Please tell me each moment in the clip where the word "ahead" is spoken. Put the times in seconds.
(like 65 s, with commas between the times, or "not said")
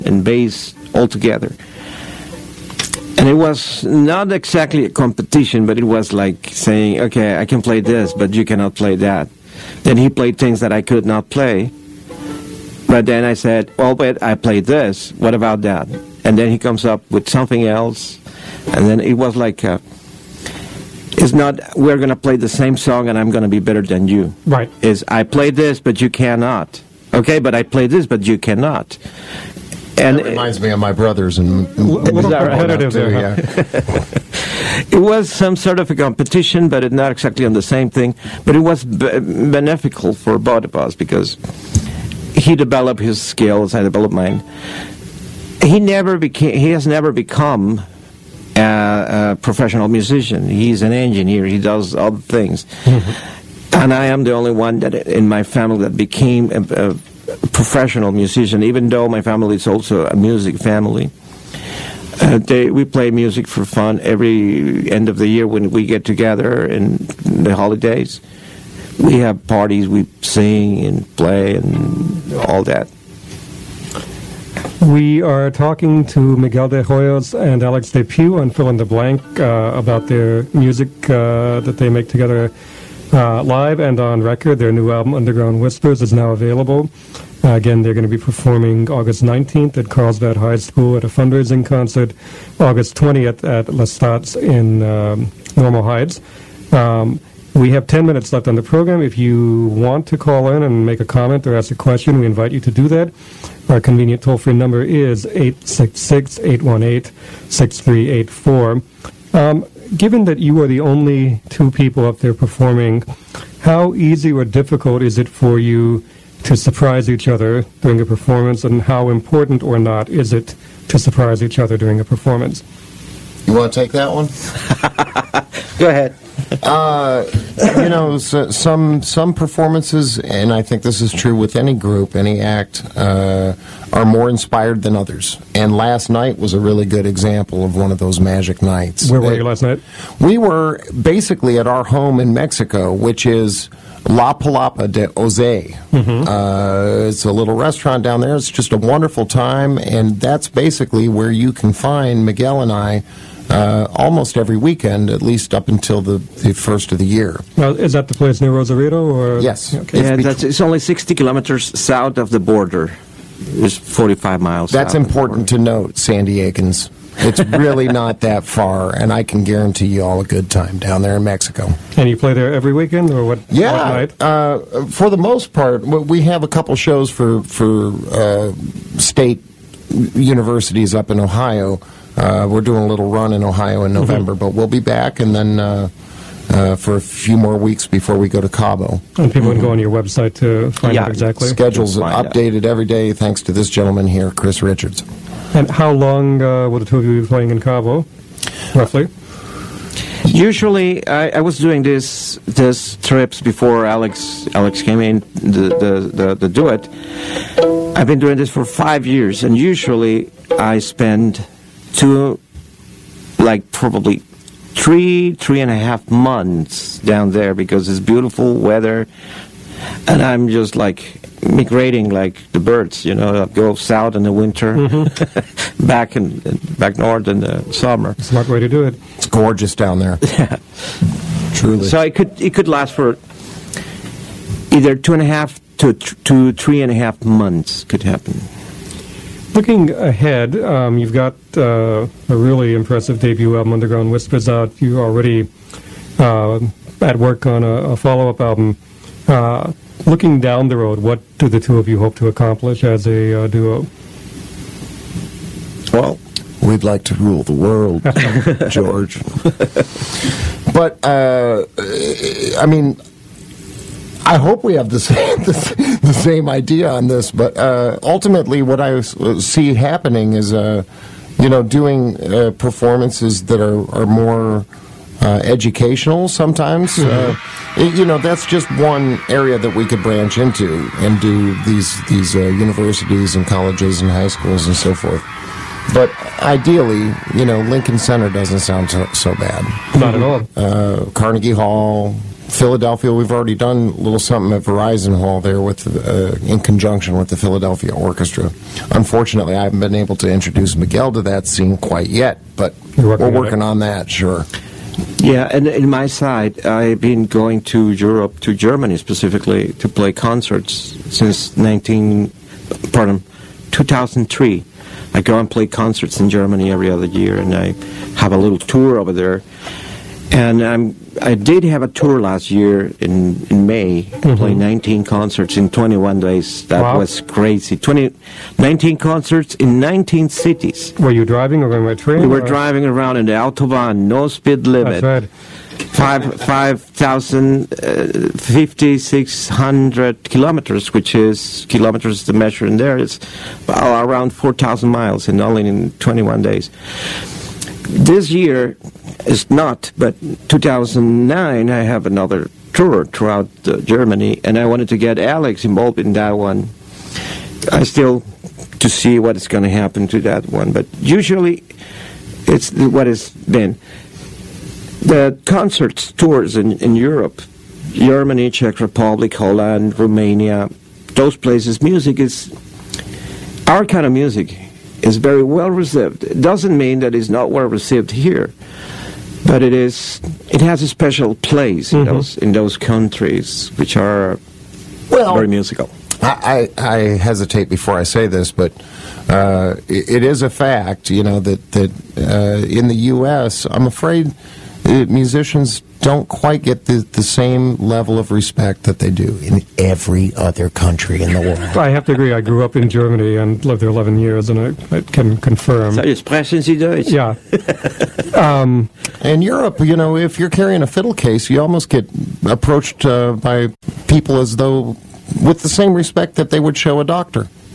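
125 s, 239 s.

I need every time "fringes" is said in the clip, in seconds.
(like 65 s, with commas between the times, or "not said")
not said.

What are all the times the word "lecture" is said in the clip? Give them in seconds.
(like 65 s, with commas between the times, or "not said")
not said.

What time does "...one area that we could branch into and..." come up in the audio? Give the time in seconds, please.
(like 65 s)
278 s.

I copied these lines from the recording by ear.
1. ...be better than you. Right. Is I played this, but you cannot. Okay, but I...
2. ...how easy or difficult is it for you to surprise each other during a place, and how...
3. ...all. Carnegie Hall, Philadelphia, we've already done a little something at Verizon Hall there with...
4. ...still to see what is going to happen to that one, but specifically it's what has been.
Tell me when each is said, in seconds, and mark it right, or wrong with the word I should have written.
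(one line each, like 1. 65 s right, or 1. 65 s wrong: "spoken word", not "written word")
1. 23 s right
2. 113 s wrong: "performance", not "place"
3. 290 s right
4. 357 s wrong: "usually", not "specifically".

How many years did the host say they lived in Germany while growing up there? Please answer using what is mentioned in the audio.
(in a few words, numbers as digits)
11 years.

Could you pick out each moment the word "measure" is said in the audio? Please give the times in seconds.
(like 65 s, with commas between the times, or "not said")
342 s.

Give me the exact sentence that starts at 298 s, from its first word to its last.
Unfortunately, I haven't been able to introduce Miguel to that scene quite yet, but working we're working on, on that, sure.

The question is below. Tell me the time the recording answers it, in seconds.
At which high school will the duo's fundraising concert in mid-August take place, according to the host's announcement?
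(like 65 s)
89 s.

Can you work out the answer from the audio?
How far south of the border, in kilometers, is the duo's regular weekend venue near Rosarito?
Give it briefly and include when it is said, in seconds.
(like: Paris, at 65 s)
60 kilometers, at 160 s.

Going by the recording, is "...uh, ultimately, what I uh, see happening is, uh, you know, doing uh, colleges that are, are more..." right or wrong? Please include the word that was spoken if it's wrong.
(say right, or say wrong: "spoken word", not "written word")
wrong: "performances", not "colleges".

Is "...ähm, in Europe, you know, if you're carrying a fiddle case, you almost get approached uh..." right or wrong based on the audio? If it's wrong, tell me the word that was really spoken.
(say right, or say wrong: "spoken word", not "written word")
right.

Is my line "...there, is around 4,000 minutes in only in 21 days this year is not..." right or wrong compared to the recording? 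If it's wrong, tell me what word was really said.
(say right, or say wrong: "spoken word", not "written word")
wrong: "miles", not "minutes".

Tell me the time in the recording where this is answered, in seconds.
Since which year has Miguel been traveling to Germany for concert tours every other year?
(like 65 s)
313 s.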